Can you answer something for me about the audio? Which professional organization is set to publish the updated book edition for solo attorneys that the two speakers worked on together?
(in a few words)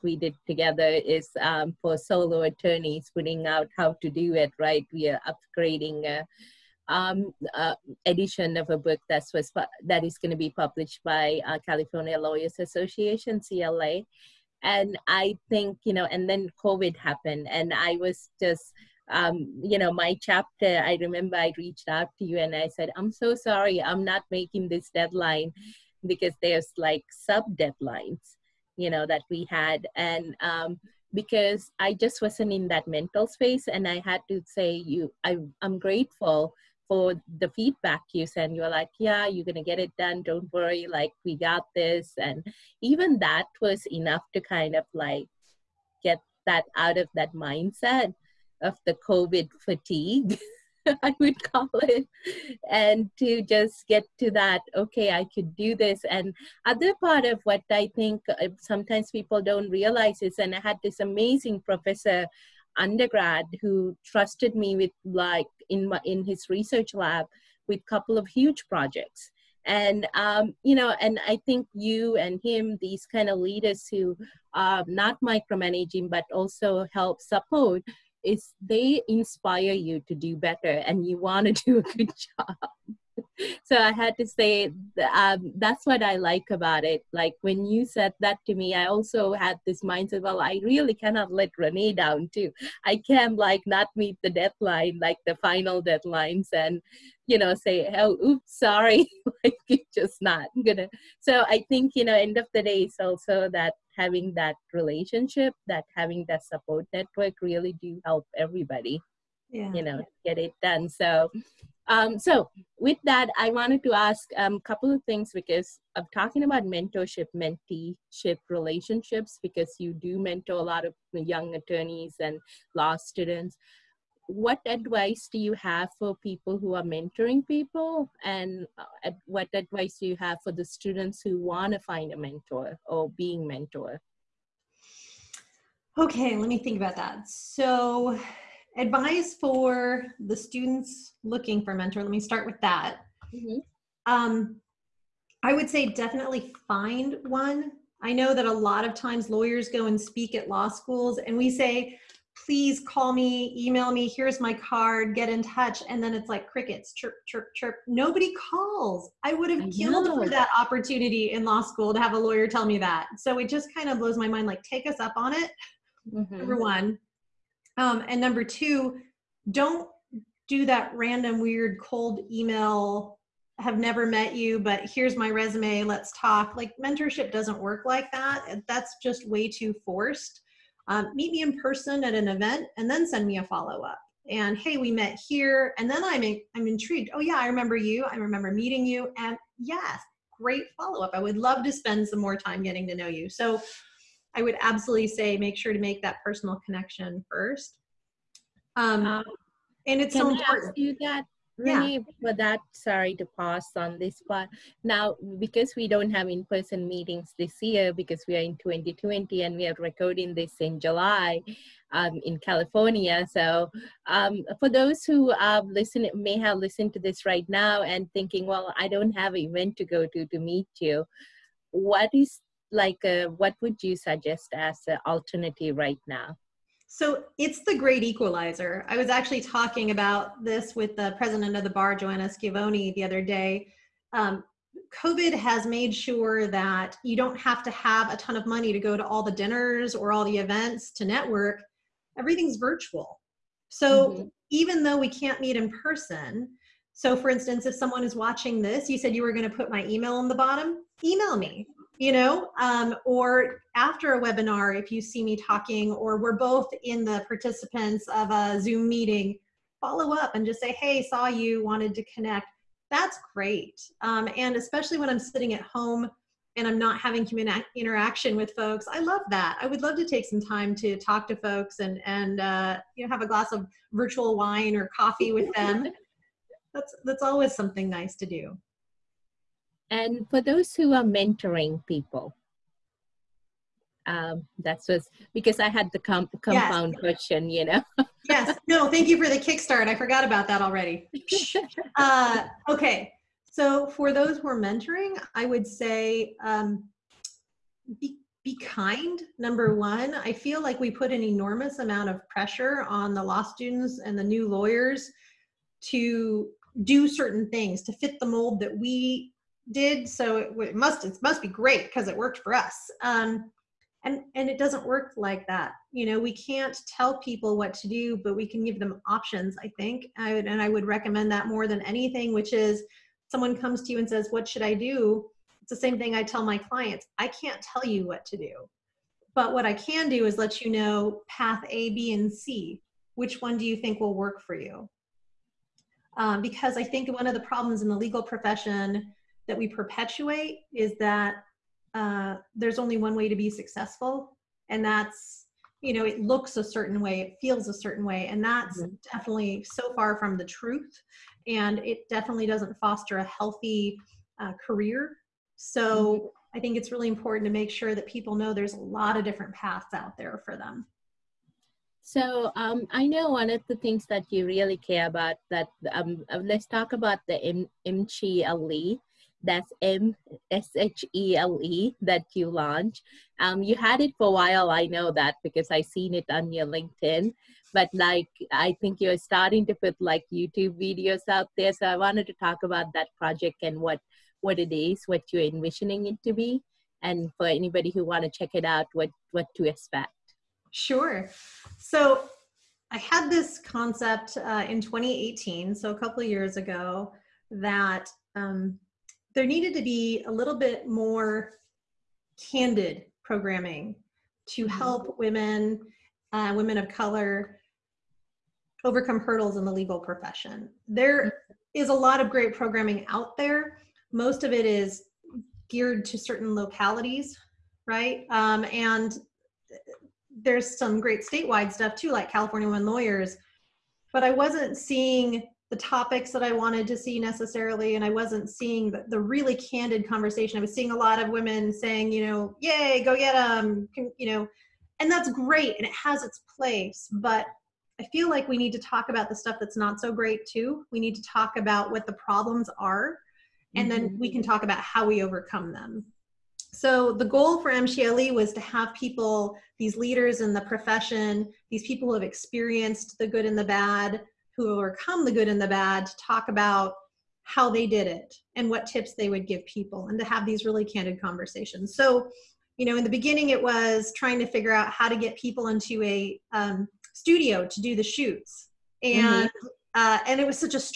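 California Lawyers Association.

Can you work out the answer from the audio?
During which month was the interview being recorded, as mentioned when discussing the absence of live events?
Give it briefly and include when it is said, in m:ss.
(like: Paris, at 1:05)
July, at 3:30.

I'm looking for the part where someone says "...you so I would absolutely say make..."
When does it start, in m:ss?
3:13.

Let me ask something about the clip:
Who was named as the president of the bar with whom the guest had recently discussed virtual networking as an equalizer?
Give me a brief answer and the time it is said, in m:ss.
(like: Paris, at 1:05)
Joanna Schiavoni, at 3:51.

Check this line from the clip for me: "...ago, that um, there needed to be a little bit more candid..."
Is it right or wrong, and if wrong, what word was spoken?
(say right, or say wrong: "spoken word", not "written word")
right.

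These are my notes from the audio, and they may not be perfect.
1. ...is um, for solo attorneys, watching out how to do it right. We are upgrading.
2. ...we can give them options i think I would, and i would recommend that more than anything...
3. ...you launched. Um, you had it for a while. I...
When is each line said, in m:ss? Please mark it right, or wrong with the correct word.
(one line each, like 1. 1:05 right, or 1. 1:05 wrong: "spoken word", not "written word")
1. 0:00 wrong: "putting", not "watching"
2. 5:18 right
3. 6:12 right.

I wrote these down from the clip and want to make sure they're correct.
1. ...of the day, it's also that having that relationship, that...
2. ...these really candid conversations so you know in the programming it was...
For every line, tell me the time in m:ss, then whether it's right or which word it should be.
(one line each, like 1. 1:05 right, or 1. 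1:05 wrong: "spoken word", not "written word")
1. 1:42 right
2. 7:40 wrong: "beginning", not "programming".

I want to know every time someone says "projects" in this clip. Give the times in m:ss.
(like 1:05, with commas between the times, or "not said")
1:08, 6:23.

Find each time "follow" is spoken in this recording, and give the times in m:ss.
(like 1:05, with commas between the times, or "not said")
3:03, 3:10, 4:19.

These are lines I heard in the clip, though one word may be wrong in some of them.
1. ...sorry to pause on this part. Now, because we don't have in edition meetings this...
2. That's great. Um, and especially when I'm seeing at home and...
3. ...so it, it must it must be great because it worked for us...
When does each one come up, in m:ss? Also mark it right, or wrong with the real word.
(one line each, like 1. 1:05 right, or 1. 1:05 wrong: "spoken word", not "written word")
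1. 3:22 wrong: "person", not "edition"
2. 4:22 wrong: "sitting", not "seeing"
3. 5:10 right.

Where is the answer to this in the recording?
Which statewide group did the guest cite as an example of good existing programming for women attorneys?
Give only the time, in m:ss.
7:02.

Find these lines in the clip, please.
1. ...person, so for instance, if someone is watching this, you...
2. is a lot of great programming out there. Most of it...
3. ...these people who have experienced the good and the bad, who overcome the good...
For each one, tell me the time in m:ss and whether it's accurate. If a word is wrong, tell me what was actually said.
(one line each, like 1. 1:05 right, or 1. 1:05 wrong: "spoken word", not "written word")
1. 4:05 right
2. 6:51 right
3. 7:31 right.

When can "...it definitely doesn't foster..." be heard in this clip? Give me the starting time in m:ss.
5:51.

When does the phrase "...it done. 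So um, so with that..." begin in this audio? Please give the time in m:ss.
1:50.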